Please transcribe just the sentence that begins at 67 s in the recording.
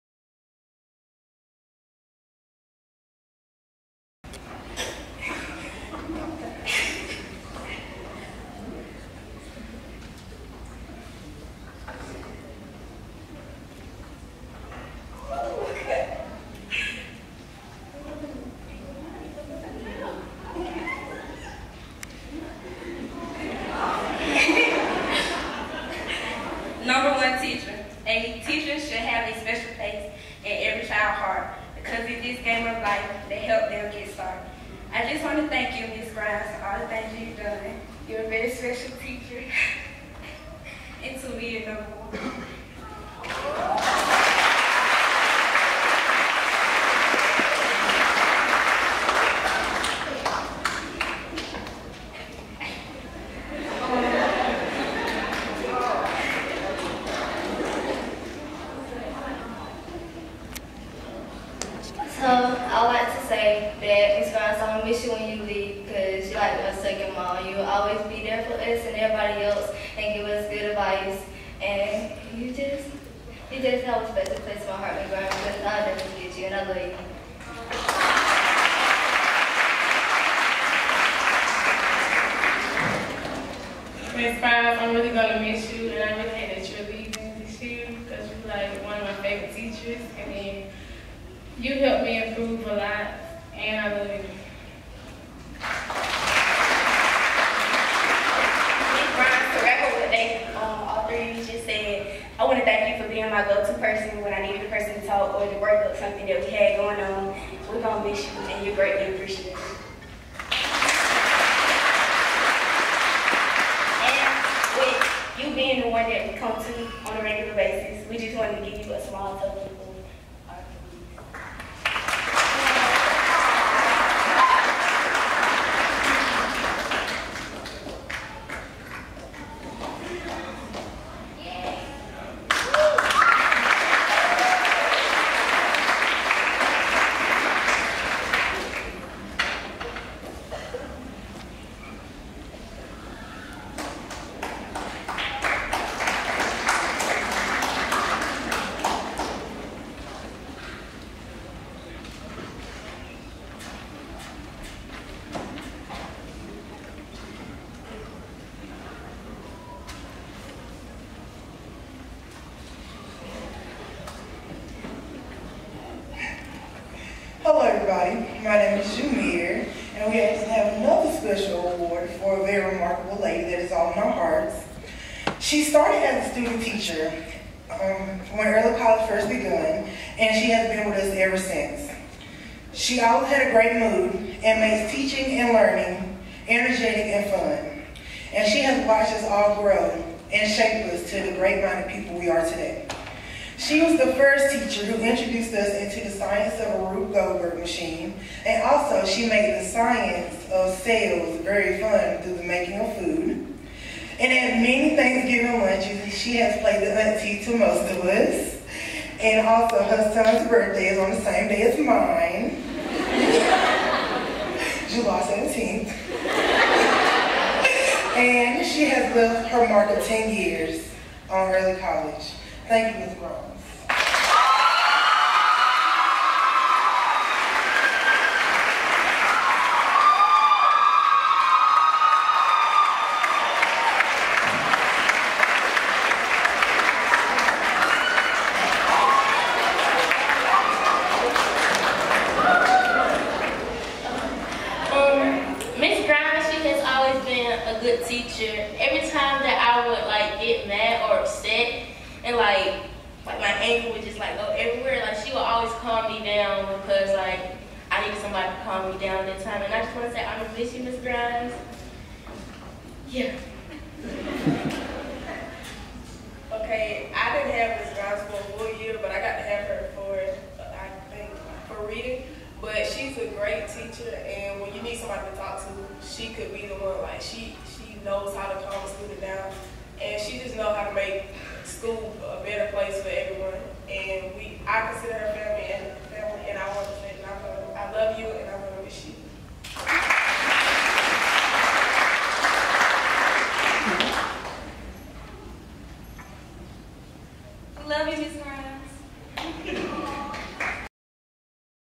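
You will always be there for us and everybody else and give us good advice.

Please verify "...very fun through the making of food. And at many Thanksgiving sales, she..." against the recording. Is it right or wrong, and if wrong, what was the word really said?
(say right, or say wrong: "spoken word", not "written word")
wrong: "lunches", not "sales".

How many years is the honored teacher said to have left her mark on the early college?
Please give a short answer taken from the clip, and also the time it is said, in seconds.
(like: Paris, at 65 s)
10, at 220 s.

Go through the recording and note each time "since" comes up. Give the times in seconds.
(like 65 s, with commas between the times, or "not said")
181 s.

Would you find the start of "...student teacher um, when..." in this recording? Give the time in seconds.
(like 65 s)
176 s.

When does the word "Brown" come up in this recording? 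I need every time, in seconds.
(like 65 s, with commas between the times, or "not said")
223 s, 246 s.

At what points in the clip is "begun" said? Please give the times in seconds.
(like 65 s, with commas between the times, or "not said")
179 s.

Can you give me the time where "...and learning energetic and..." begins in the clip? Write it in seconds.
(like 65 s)
185 s.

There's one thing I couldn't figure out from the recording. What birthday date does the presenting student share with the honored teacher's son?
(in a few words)
July 17th.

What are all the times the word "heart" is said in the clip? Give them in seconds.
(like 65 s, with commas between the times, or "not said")
31 s, 74 s, 174 s.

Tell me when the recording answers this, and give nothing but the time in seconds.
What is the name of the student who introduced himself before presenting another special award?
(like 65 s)
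168 s.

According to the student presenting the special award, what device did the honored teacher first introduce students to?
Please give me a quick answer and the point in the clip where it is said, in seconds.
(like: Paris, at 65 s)
Rube Goldberg machine, at 196 s.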